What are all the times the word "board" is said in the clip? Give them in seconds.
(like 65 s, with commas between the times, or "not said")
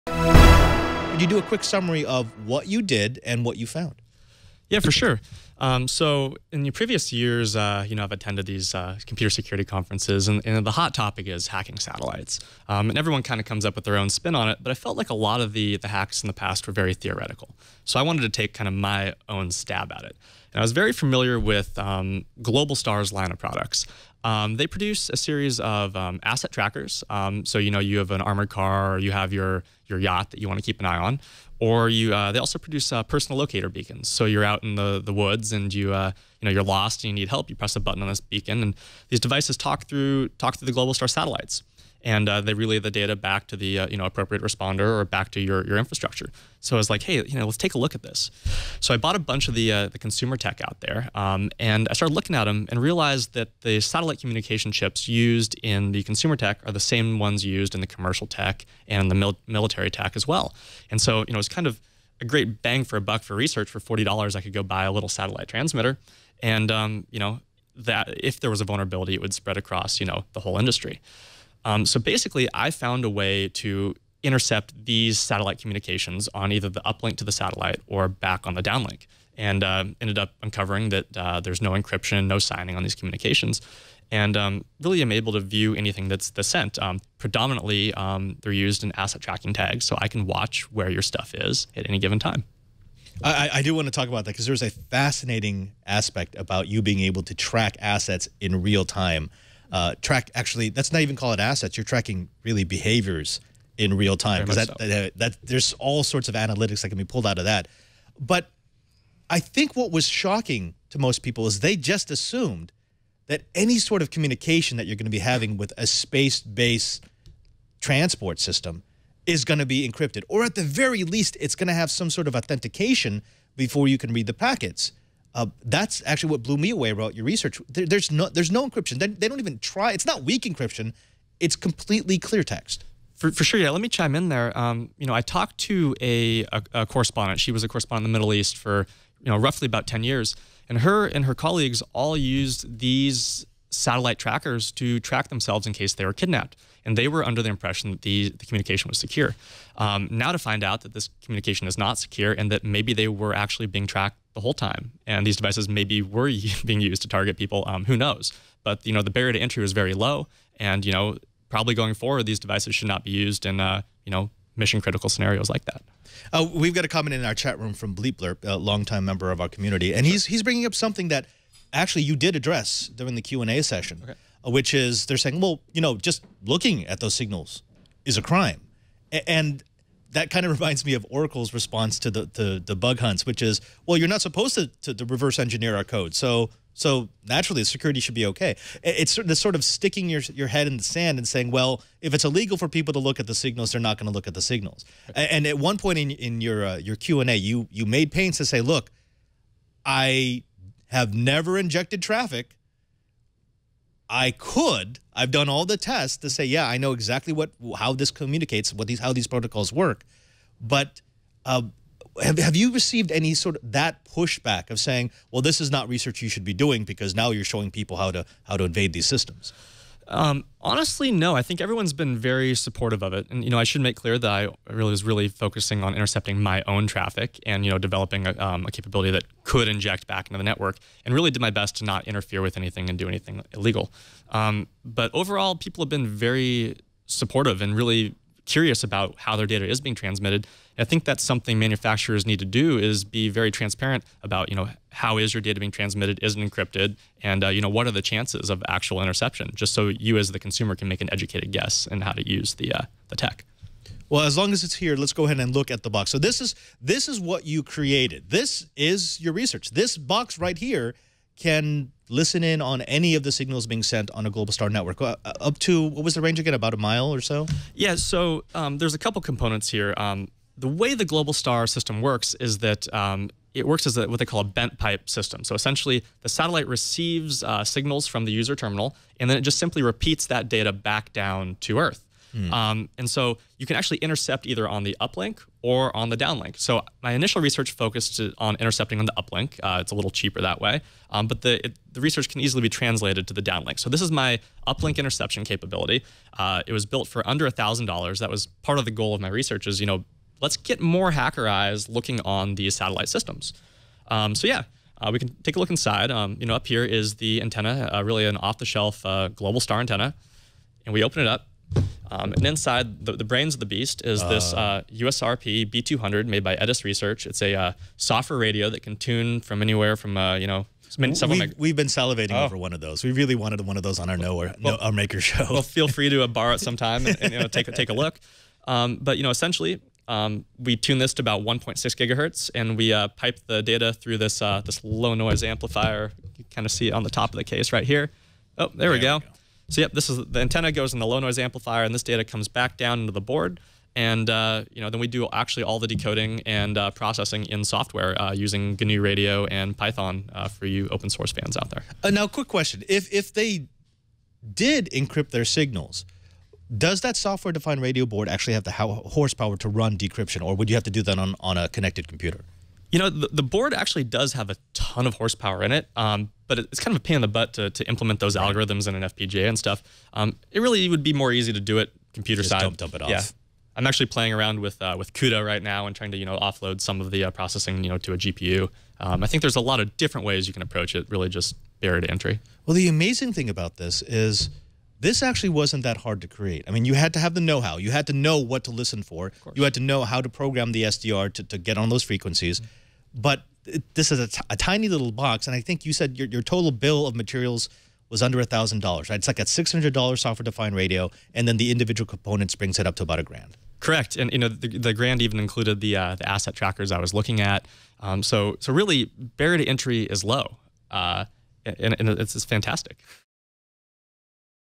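343 s, 358 s, 363 s.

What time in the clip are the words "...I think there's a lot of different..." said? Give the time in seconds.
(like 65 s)
379 s.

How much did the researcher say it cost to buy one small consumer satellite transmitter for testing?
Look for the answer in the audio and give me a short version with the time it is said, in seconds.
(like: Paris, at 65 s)
$40, at 63 s.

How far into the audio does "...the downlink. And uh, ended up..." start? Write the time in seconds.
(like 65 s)
78 s.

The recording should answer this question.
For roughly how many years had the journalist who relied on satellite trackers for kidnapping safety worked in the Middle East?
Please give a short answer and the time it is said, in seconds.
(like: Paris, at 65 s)
10 years, at 139 s.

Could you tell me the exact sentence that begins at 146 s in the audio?
And they were under the impression that the, the communication was secure.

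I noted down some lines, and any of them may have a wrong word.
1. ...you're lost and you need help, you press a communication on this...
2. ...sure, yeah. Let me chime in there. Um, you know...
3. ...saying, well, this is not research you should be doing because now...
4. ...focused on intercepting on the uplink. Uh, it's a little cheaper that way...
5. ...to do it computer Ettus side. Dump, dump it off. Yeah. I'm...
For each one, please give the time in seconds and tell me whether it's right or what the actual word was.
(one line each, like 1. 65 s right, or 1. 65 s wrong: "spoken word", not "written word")
1. 36 s wrong: "button", not "communication"
2. 133 s right
3. 214 s right
4. 287 s right
5. 371 s wrong: "Just", not "Ettus".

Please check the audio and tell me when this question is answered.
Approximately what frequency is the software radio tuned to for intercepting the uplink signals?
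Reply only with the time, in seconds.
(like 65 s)
331 s.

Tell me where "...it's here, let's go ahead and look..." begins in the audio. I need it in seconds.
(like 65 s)
254 s.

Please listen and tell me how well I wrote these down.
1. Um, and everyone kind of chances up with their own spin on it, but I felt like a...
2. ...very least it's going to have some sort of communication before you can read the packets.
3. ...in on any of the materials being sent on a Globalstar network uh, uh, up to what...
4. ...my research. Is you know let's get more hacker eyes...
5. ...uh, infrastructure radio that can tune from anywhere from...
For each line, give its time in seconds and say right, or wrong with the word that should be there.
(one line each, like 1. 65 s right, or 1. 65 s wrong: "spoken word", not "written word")
1. 12 s wrong: "comes", not "chances"
2. 120 s wrong: "authentication", not "communication"
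3. 262 s wrong: "signals", not "materials"
4. 299 s right
5. 317 s wrong: "software", not "infrastructure".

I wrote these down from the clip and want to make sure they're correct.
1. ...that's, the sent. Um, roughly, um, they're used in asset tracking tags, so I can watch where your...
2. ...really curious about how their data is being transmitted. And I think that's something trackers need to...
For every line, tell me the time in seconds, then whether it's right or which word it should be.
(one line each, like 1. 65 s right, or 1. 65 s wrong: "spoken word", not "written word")
1. 86 s wrong: "predominantly", not "roughly"
2. 237 s wrong: "manufacturers", not "trackers".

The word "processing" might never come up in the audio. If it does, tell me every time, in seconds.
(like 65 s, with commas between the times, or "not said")
346 s, 377 s.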